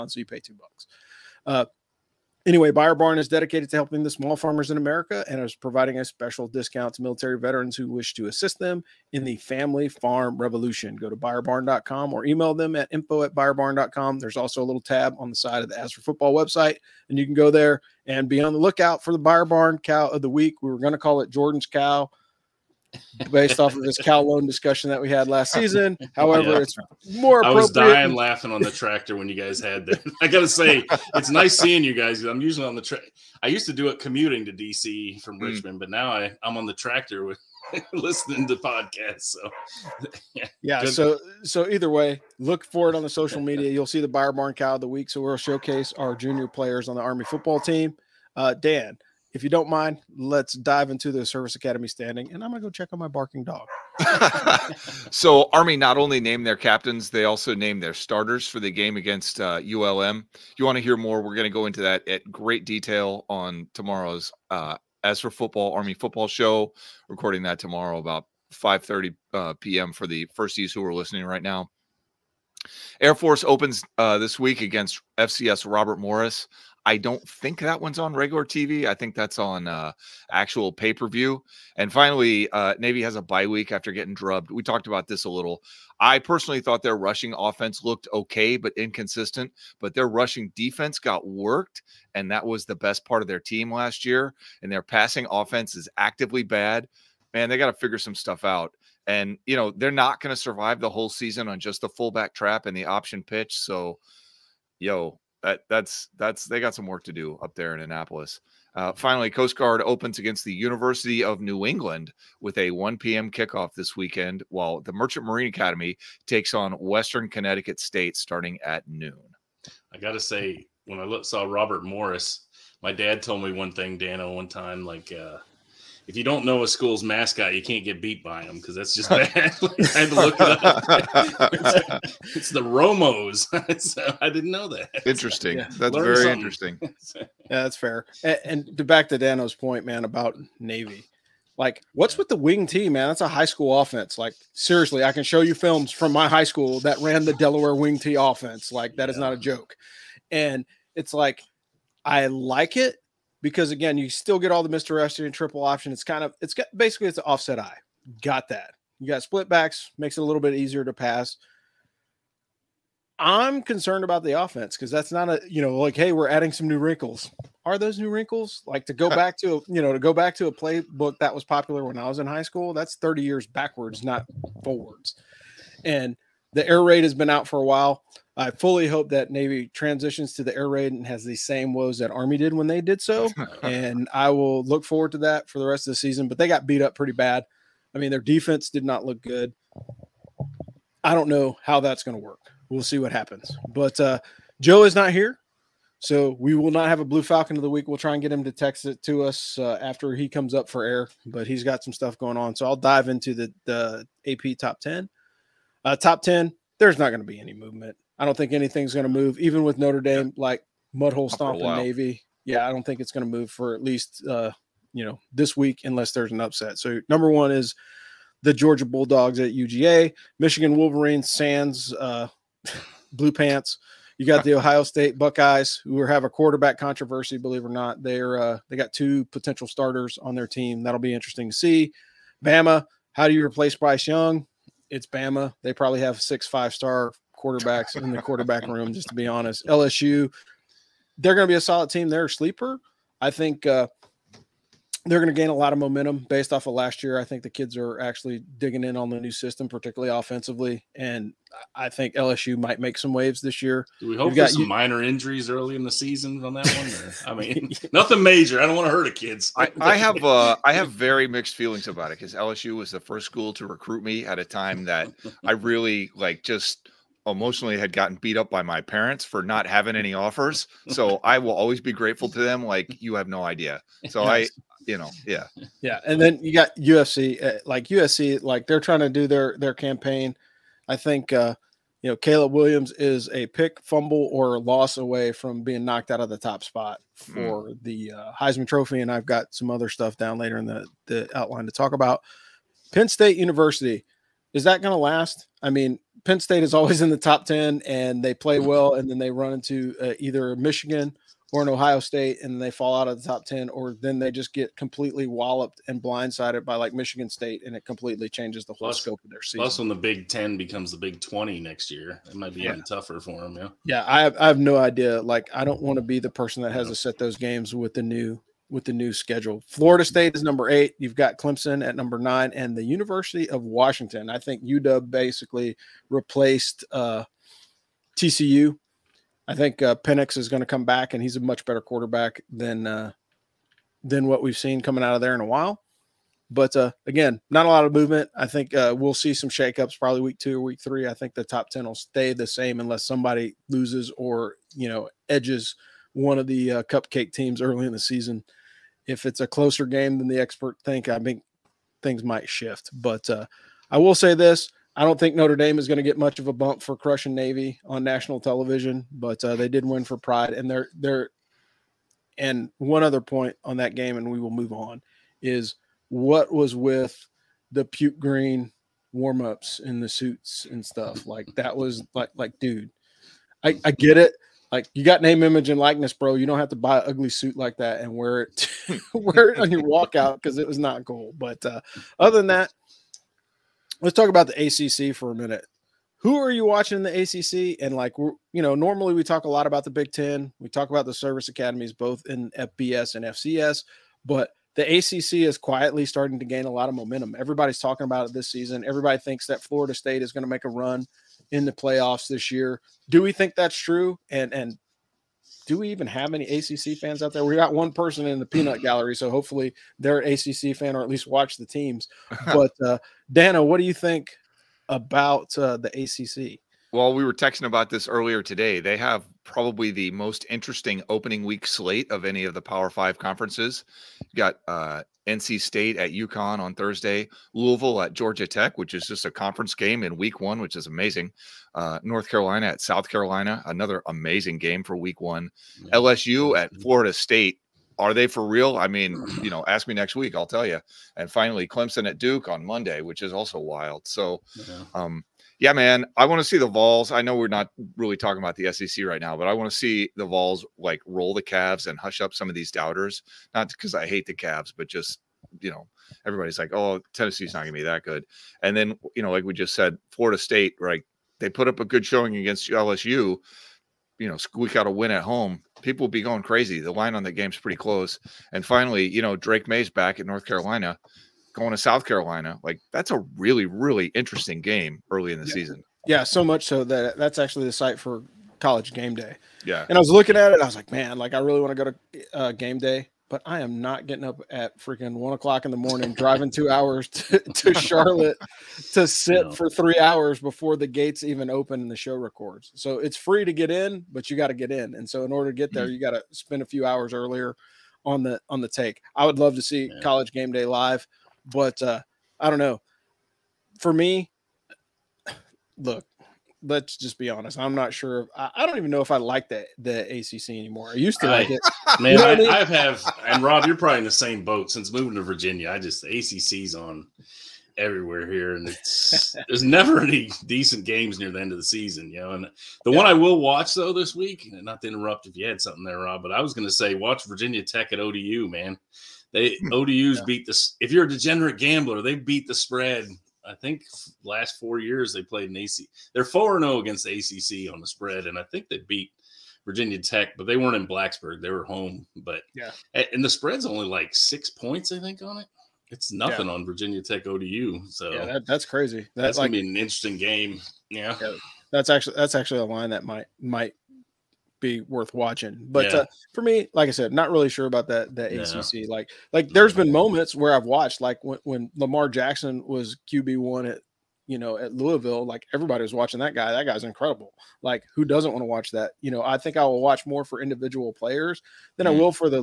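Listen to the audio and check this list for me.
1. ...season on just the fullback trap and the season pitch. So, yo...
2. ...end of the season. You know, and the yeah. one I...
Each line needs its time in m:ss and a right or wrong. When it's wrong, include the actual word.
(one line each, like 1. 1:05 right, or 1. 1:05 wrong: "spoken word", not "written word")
1. 1:41 wrong: "option", not "season"
2. 8:41 right.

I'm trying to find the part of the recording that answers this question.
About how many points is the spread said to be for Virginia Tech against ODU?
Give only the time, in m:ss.
9:04.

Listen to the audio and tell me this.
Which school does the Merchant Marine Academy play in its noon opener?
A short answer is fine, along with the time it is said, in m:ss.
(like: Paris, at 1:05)
Western Connecticut State, at 1:56.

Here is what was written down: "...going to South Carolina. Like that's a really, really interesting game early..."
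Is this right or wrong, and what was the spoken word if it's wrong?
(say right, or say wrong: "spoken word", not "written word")
right.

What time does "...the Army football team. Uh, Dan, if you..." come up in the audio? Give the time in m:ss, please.
0:46.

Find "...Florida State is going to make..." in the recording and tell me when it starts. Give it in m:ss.
6:39.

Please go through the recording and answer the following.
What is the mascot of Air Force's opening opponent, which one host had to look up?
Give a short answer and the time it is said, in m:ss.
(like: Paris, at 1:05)
Romos, at 2:12.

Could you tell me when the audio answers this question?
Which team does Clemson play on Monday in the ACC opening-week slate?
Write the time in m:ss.
7:22.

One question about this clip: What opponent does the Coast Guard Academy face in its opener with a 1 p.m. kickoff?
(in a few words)
University of New England.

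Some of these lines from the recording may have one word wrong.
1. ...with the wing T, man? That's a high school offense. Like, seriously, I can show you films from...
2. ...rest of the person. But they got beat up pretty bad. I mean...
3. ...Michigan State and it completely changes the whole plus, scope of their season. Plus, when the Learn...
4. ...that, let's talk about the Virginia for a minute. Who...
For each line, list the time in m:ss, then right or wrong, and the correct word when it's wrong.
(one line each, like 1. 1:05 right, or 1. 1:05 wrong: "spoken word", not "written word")
1. 2:22 right
2. 3:05 wrong: "season", not "person"
3. 5:06 wrong: "Big", not "Learn"
4. 6:22 wrong: "ACC", not "Virginia".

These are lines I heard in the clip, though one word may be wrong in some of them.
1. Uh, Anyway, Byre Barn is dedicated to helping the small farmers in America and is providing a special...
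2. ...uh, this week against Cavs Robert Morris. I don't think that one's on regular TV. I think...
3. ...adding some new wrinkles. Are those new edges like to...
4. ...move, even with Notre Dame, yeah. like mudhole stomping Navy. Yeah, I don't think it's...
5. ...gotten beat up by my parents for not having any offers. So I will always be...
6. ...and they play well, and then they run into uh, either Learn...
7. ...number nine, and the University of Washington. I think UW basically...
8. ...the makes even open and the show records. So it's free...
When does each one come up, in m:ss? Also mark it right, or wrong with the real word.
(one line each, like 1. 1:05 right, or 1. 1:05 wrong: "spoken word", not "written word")
1. 0:01 right
2. 1:13 wrong: "FCS", not "Cavs"
3. 2:46 wrong: "wrinkles", not "edges"
4. 3:29 right
5. 4:27 right
6. 4:57 wrong: "Michigan", not "Learn"
7. 5:21 right
8. 8:10 wrong: "gates", not "makes".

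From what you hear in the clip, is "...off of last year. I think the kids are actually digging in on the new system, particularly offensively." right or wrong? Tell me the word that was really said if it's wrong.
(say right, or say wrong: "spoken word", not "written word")
right.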